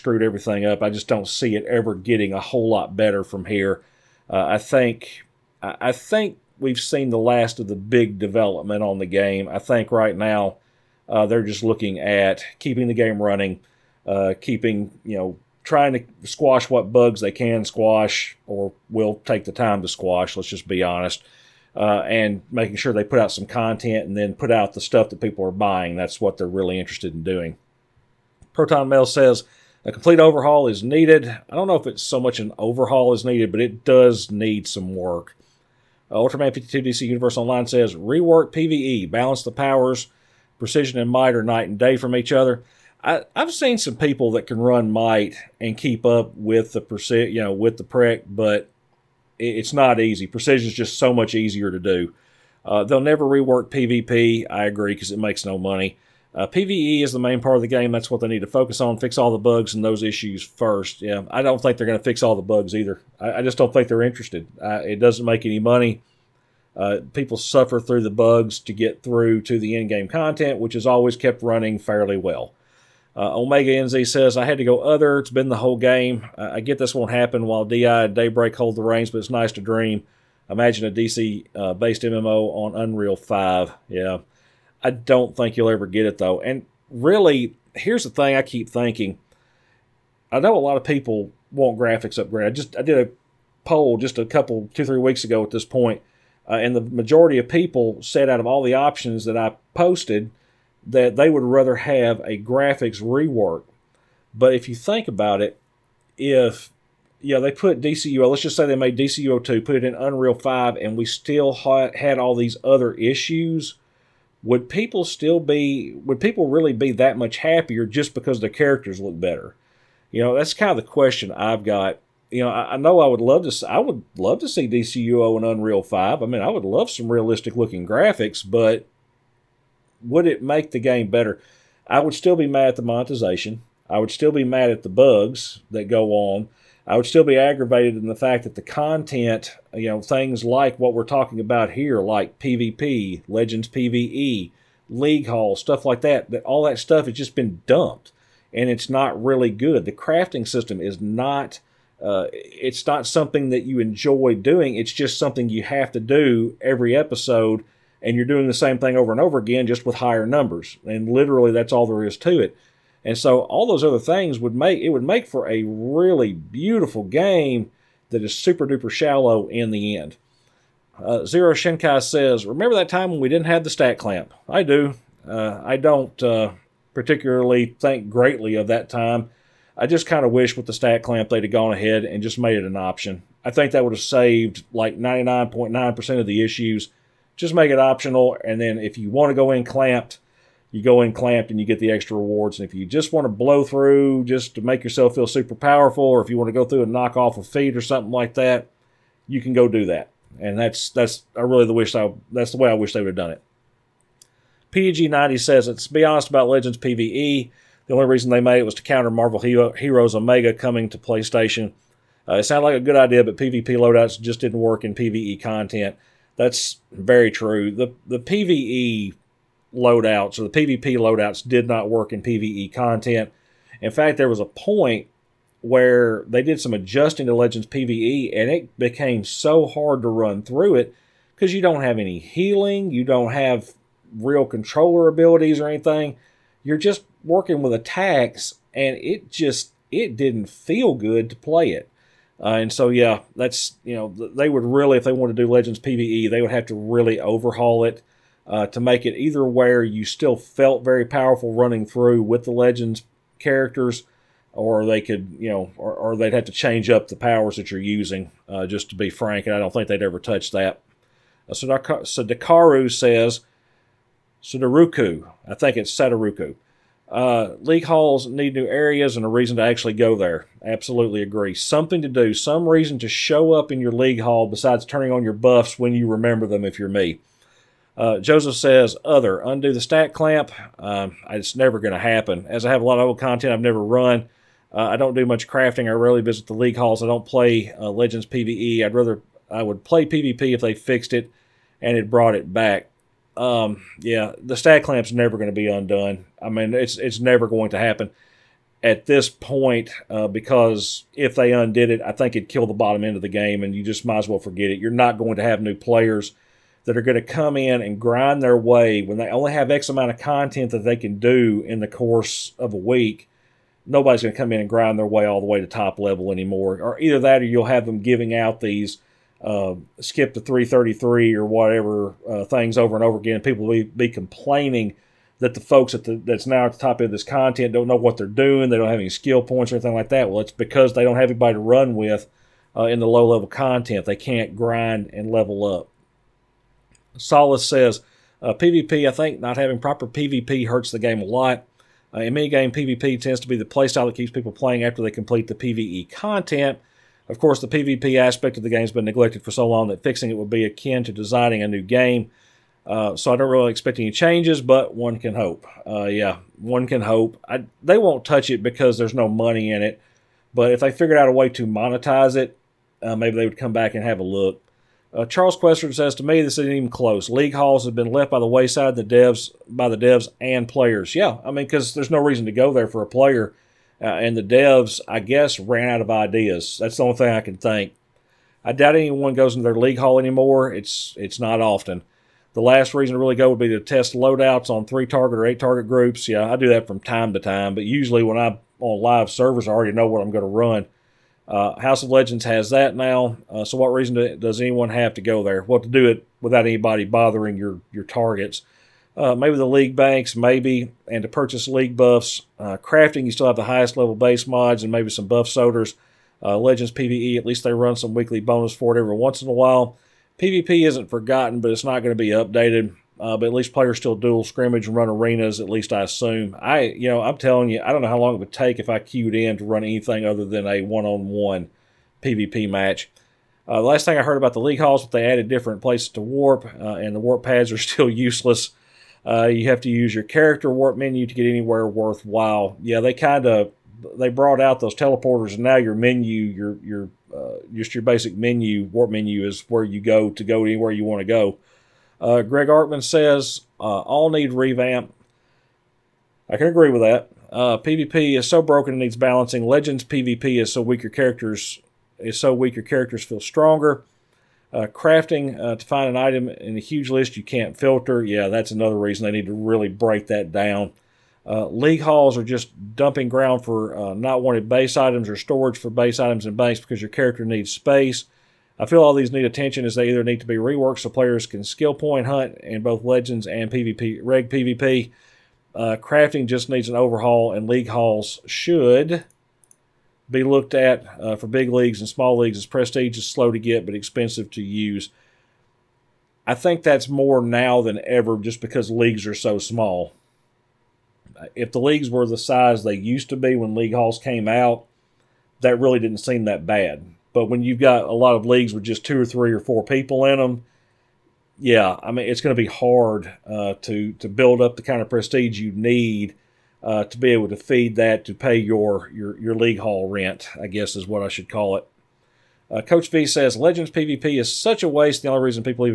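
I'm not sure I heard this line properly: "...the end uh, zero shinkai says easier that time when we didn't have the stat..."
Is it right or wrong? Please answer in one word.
wrong.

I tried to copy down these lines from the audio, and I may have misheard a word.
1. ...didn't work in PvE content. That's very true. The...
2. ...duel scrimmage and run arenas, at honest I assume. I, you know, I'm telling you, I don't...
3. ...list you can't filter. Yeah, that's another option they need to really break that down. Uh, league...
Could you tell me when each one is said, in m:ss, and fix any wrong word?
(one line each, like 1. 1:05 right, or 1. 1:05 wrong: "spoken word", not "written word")
1. 3:34 right
2. 6:54 wrong: "least", not "honest"
3. 7:37 wrong: "reason", not "option".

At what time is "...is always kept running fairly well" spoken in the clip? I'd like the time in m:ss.
1:10.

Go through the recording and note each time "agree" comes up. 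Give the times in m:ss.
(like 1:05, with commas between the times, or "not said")
0:54, 4:31, 7:26.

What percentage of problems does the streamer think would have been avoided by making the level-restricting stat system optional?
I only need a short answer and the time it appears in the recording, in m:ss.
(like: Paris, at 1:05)
99.9%, at 3:04.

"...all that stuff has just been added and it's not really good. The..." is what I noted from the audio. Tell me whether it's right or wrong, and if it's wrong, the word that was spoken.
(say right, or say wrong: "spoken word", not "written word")
wrong: "dumped", not "added".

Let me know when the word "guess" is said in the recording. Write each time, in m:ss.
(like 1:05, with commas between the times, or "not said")
6:15, 8:30.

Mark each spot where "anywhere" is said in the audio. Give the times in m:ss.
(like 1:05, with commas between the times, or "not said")
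7:11, 7:20.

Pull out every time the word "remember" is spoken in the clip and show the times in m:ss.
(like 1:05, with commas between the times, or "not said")
2:52, 4:36.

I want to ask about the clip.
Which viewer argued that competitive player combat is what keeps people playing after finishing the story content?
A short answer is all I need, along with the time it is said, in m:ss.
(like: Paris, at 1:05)
Solace, at 5:37.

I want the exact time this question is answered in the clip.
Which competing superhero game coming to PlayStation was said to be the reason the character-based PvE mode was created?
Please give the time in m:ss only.
3:29.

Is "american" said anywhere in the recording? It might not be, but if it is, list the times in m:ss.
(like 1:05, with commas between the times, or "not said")
not said.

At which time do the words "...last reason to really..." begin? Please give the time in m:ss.
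6:22.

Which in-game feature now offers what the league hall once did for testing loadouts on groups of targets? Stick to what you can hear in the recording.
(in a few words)
House of Legends.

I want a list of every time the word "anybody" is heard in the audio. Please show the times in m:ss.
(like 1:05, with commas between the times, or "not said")
5:31, 6:36.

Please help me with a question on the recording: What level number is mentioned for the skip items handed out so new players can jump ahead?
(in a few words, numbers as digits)
333.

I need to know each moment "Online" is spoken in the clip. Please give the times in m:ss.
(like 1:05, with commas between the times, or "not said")
0:37.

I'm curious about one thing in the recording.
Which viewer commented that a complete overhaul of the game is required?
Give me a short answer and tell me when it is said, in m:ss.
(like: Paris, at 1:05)
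Proton Mail, at 0:28.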